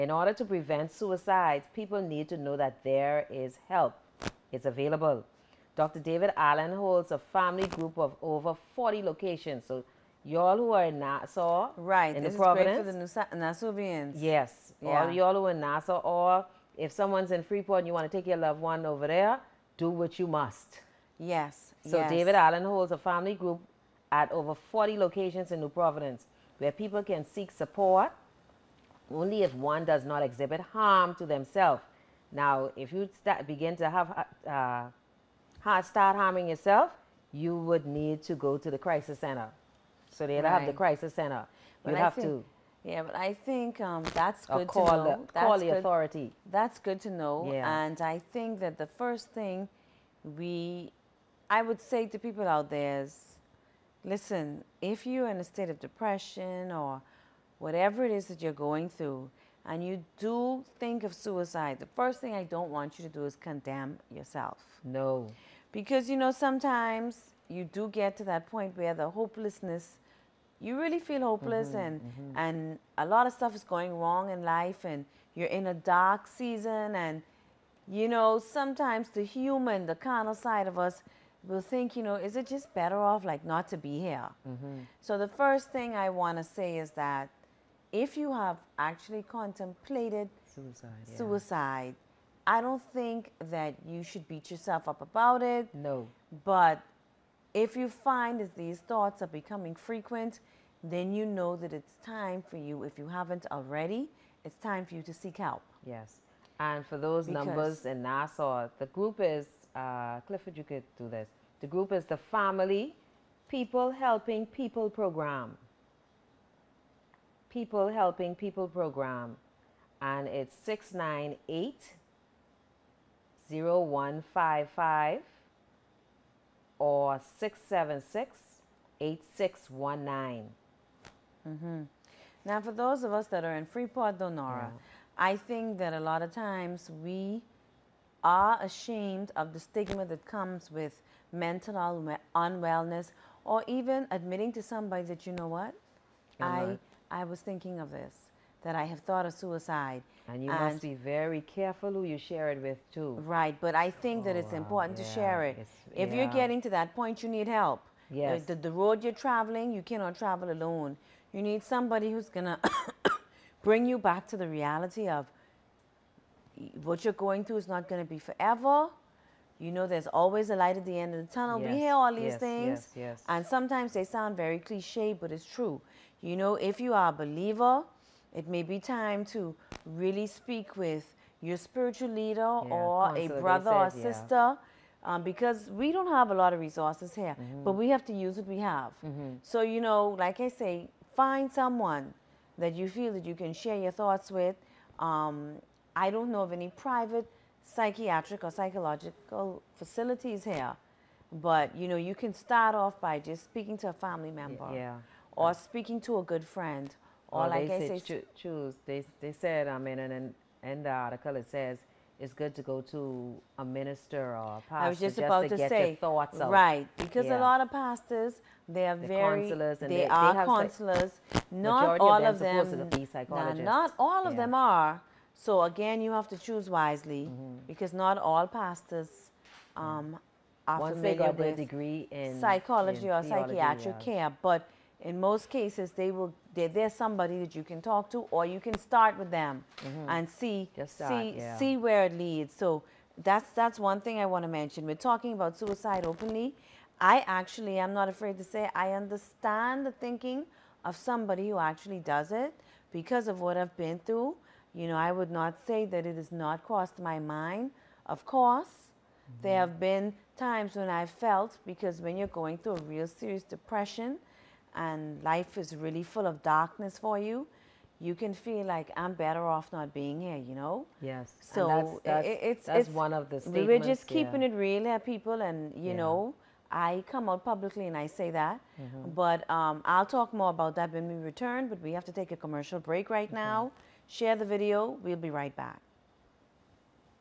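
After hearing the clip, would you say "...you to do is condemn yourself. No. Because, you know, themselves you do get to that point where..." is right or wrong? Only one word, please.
wrong.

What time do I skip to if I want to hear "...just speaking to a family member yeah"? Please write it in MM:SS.
03:23.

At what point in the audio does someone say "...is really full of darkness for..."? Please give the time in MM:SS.
04:25.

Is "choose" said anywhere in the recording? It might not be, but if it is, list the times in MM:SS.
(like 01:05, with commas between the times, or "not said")
03:28, 03:46.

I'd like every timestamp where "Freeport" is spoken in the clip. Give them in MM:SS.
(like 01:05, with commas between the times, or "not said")
00:17, 02:13.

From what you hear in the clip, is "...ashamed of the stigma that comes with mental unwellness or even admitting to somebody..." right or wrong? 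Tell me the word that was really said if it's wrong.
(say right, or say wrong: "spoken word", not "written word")
right.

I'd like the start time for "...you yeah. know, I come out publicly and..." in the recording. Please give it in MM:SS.
04:35.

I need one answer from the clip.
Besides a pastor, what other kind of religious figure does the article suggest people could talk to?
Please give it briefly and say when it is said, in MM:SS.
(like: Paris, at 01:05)
minister, at 03:33.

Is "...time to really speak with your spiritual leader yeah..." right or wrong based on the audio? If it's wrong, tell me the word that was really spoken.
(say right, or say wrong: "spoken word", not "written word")
right.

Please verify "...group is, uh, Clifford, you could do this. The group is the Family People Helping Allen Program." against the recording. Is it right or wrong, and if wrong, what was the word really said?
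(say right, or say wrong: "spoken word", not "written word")
wrong: "People", not "Allen".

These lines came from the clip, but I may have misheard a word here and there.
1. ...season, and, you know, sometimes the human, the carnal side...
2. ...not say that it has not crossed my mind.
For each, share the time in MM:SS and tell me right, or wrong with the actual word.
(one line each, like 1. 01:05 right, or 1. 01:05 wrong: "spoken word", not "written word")
1. 01:16 right
2. 04:15 right.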